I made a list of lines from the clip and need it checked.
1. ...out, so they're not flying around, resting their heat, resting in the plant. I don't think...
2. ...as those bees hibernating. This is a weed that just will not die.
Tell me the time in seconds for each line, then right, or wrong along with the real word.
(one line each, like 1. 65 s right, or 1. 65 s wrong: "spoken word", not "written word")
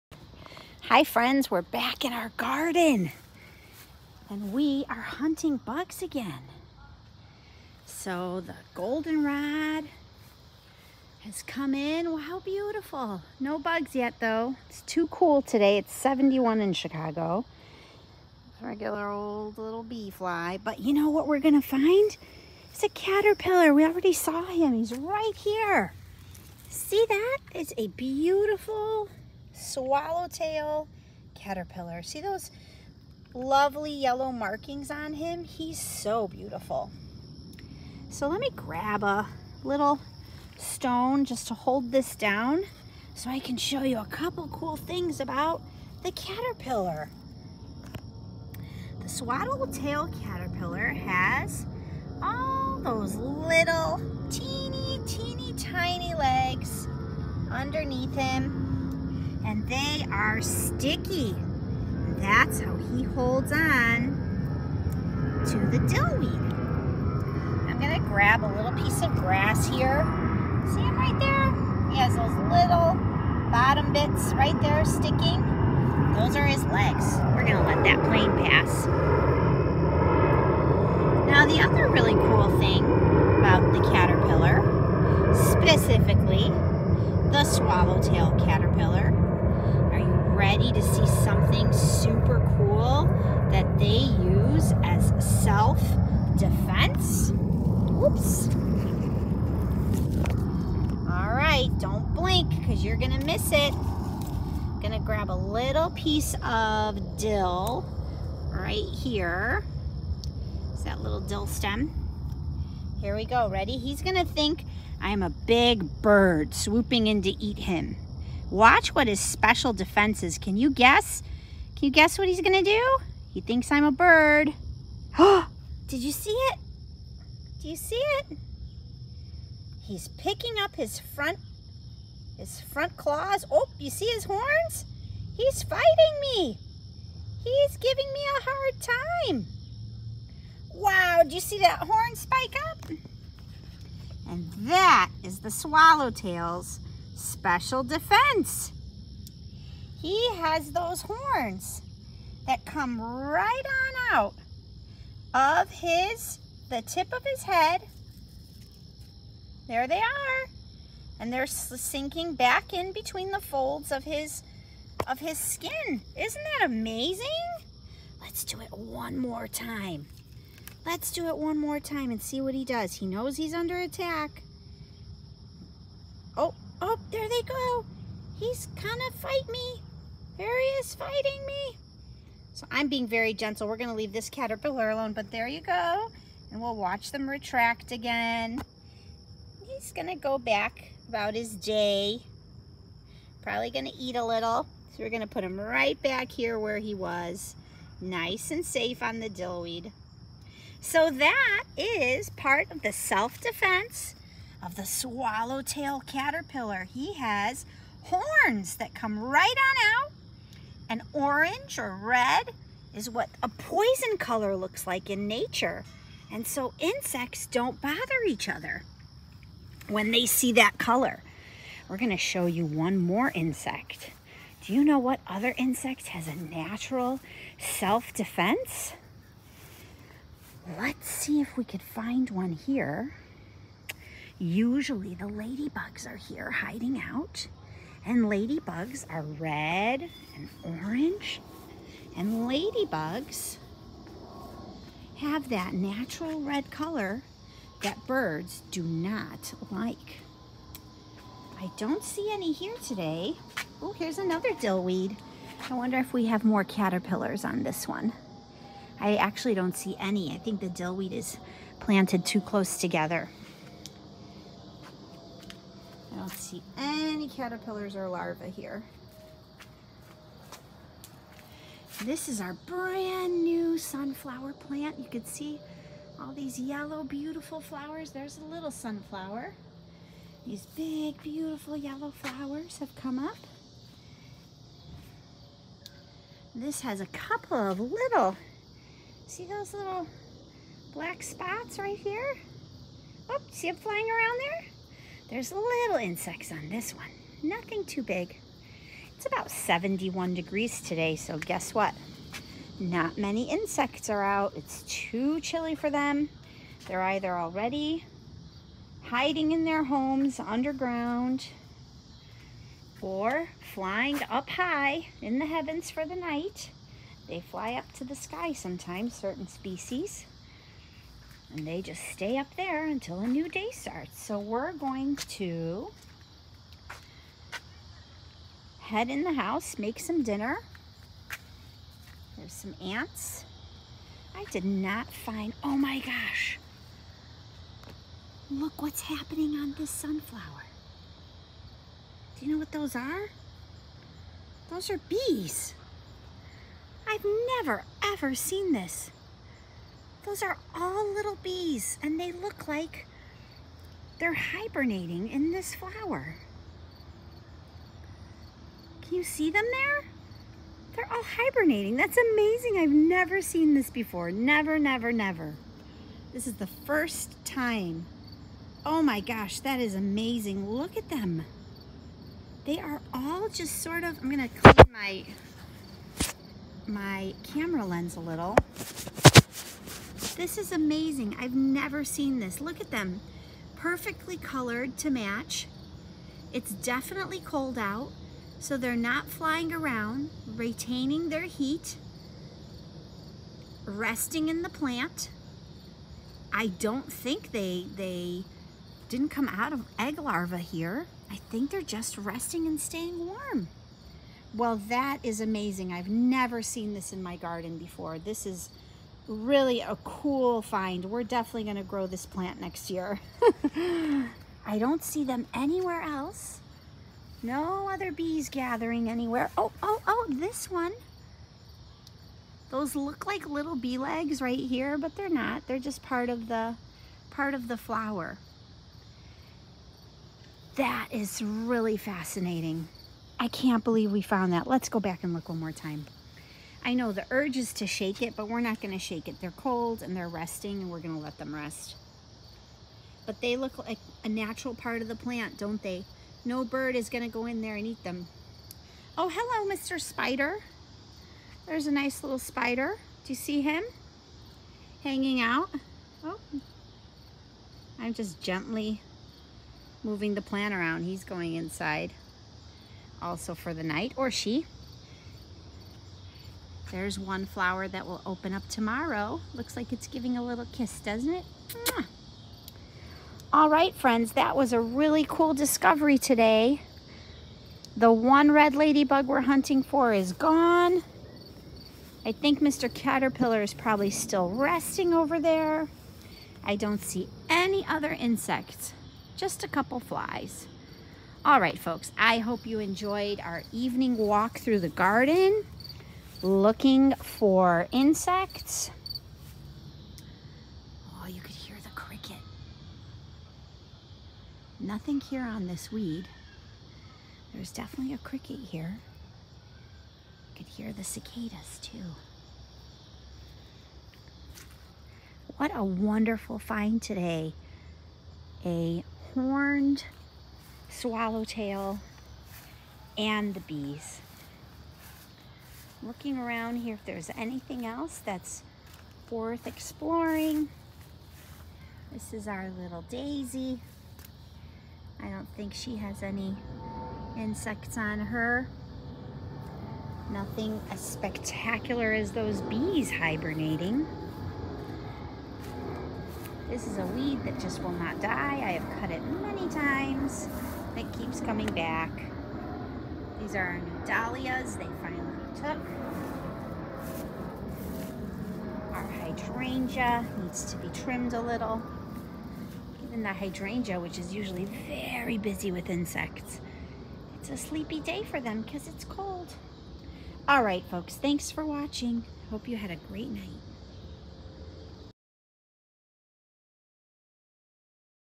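1. 387 s wrong: "retaining", not "resting"
2. 542 s right.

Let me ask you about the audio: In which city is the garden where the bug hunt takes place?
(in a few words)
Chicago.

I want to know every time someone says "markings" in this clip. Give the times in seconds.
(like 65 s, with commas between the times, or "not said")
34 s.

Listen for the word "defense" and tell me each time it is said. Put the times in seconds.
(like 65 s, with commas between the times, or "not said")
96 s, 119 s, 147 s, 202 s, 227 s.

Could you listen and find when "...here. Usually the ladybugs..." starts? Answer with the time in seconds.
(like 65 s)
232 s.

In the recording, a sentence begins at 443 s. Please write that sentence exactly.
But they look like a natural part of the plant, don't they?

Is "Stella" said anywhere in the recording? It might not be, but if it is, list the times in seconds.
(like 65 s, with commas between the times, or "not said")
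not said.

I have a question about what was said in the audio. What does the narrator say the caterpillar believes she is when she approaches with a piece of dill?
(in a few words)
A big bird.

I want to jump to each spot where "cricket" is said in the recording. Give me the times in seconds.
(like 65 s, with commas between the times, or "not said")
501 s, 508 s.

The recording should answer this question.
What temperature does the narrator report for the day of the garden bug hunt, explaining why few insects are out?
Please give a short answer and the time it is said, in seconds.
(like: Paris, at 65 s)
71, at 15 s.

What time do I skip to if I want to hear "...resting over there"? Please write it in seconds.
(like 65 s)
484 s.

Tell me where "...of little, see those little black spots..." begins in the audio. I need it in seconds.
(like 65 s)
287 s.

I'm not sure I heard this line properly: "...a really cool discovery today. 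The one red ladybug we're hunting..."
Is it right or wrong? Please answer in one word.
right.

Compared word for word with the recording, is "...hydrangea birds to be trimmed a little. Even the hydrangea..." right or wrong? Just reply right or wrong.
wrong.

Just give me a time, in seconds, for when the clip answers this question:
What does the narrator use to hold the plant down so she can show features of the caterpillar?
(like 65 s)
39 s.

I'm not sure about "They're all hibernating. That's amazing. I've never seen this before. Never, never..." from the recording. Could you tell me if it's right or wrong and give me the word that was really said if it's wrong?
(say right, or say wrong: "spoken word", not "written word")
right.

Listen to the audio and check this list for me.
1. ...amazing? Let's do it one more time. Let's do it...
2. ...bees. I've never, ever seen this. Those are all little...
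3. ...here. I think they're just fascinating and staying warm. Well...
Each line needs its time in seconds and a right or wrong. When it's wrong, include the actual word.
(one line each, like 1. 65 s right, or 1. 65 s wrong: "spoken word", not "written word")
1. 166 s right
2. 345 s right
3. 400 s wrong: "resting", not "fascinating".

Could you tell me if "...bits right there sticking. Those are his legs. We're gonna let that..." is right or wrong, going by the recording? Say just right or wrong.
right.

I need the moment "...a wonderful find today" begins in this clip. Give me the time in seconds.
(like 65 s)
515 s.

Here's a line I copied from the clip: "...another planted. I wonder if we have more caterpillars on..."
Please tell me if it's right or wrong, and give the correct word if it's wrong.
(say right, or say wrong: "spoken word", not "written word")
wrong: "dillweed", not "planted".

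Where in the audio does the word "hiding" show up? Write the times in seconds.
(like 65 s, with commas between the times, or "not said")
236 s, 309 s.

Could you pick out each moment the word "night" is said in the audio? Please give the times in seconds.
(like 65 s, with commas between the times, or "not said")
316 s, 463 s, 573 s.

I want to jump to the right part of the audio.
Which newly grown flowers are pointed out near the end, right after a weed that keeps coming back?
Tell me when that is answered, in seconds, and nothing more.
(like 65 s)
554 s.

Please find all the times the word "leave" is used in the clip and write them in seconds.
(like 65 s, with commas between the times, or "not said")
183 s.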